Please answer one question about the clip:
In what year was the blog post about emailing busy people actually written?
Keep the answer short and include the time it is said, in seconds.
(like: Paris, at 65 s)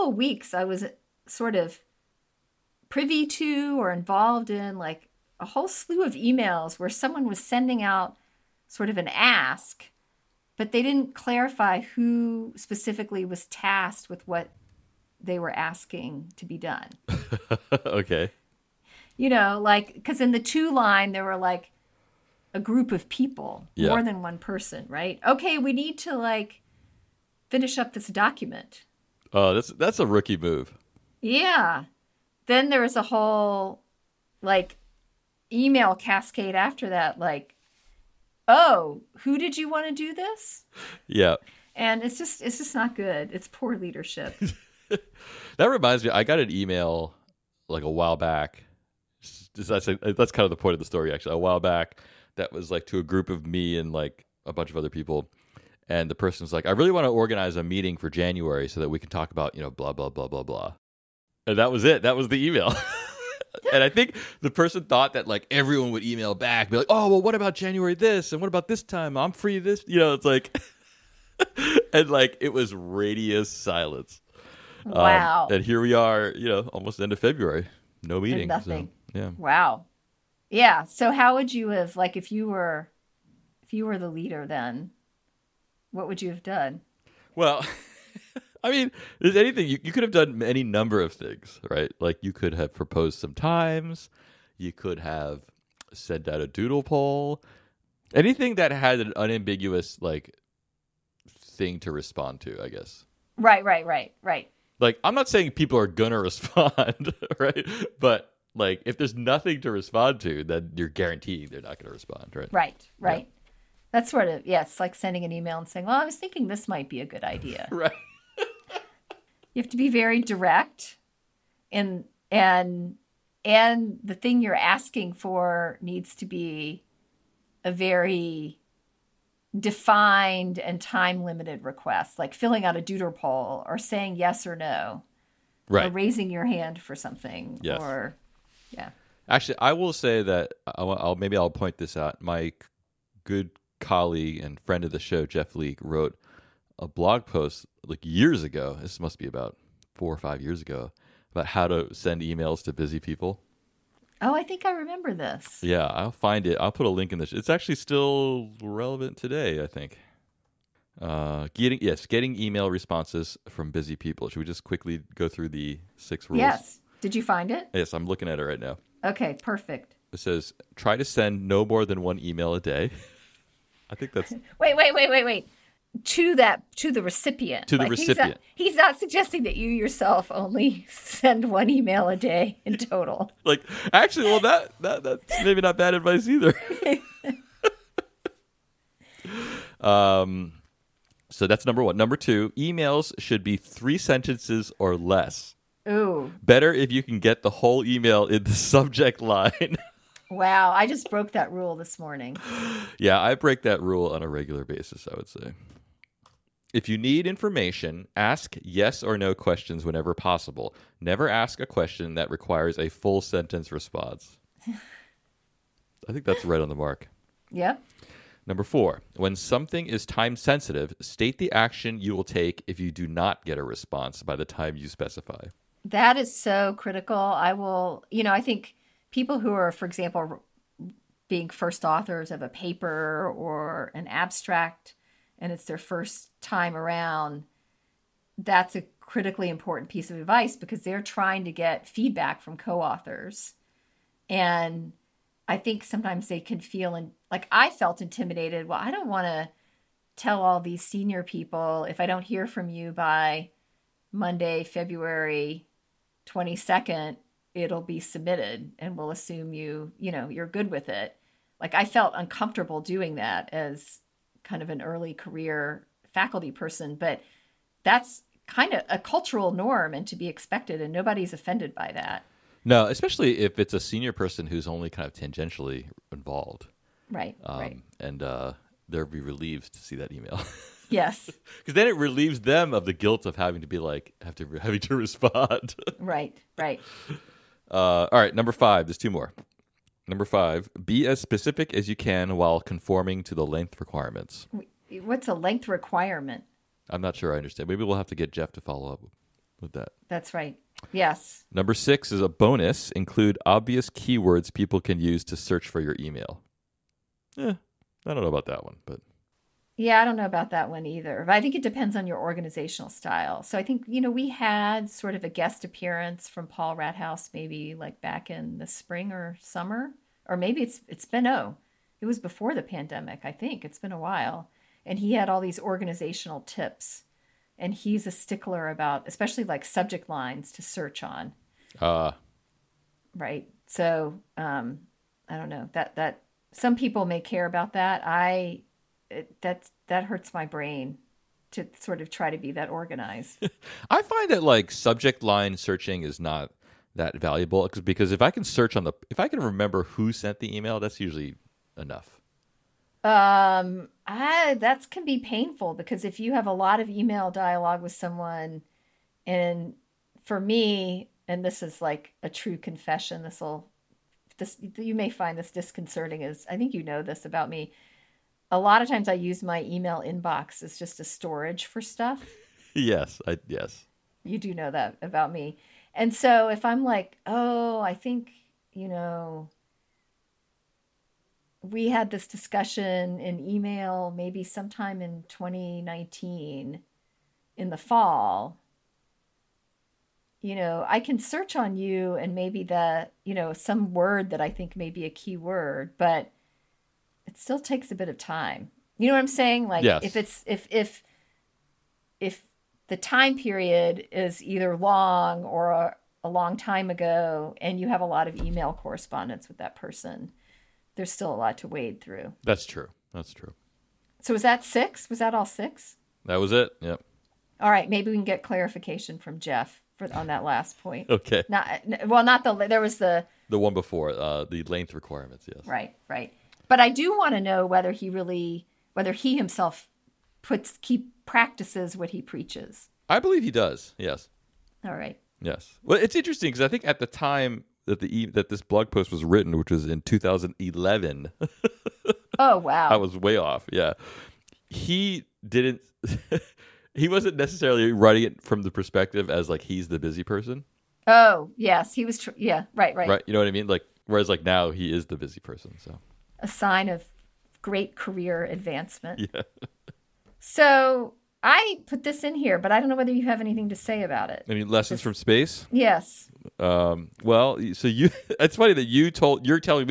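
2011, at 440 s.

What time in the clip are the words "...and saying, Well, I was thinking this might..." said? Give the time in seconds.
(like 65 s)
115 s.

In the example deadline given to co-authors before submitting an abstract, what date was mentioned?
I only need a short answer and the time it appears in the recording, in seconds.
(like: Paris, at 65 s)
Monday, February 22nd, at 254 s.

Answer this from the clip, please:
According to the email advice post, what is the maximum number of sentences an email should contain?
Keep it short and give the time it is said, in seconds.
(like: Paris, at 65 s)
3, at 193 s.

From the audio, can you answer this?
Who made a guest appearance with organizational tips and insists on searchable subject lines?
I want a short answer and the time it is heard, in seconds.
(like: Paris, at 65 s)
Paul Rathouz, at 316 s.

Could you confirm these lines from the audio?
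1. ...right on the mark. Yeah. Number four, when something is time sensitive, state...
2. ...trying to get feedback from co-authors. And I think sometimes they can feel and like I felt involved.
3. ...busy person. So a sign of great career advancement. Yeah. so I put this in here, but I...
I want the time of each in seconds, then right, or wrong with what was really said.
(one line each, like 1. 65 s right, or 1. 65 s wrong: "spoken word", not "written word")
1. 216 s right
2. 241 s wrong: "intimidated", not "involved"
3. 455 s right.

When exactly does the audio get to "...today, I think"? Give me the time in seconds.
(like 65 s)
159 s.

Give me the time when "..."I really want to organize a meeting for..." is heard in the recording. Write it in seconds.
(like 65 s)
56 s.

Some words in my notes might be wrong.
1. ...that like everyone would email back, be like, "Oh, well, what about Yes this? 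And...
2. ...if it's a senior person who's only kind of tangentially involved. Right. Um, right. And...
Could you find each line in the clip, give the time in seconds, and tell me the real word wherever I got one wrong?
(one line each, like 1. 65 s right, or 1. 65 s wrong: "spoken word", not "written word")
1. 65 s wrong: "January", not "Yes"
2. 273 s right.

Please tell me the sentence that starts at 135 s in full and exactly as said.
or raising your hand for something, yes.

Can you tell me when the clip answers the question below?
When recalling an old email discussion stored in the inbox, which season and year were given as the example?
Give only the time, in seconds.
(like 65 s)
385 s.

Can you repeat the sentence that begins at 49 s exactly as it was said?
That's that's kind of the point of the story, actually.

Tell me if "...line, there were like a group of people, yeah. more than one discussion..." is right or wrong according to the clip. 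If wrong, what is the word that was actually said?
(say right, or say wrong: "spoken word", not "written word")
wrong: "person", not "discussion".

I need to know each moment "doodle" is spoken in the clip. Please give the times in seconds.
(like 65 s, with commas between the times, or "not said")
96 s, 132 s.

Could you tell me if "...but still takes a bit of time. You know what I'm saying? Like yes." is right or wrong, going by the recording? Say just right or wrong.
right.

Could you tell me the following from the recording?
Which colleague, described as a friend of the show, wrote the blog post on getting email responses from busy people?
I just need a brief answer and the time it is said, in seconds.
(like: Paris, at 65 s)
Jeff Leek, at 145 s.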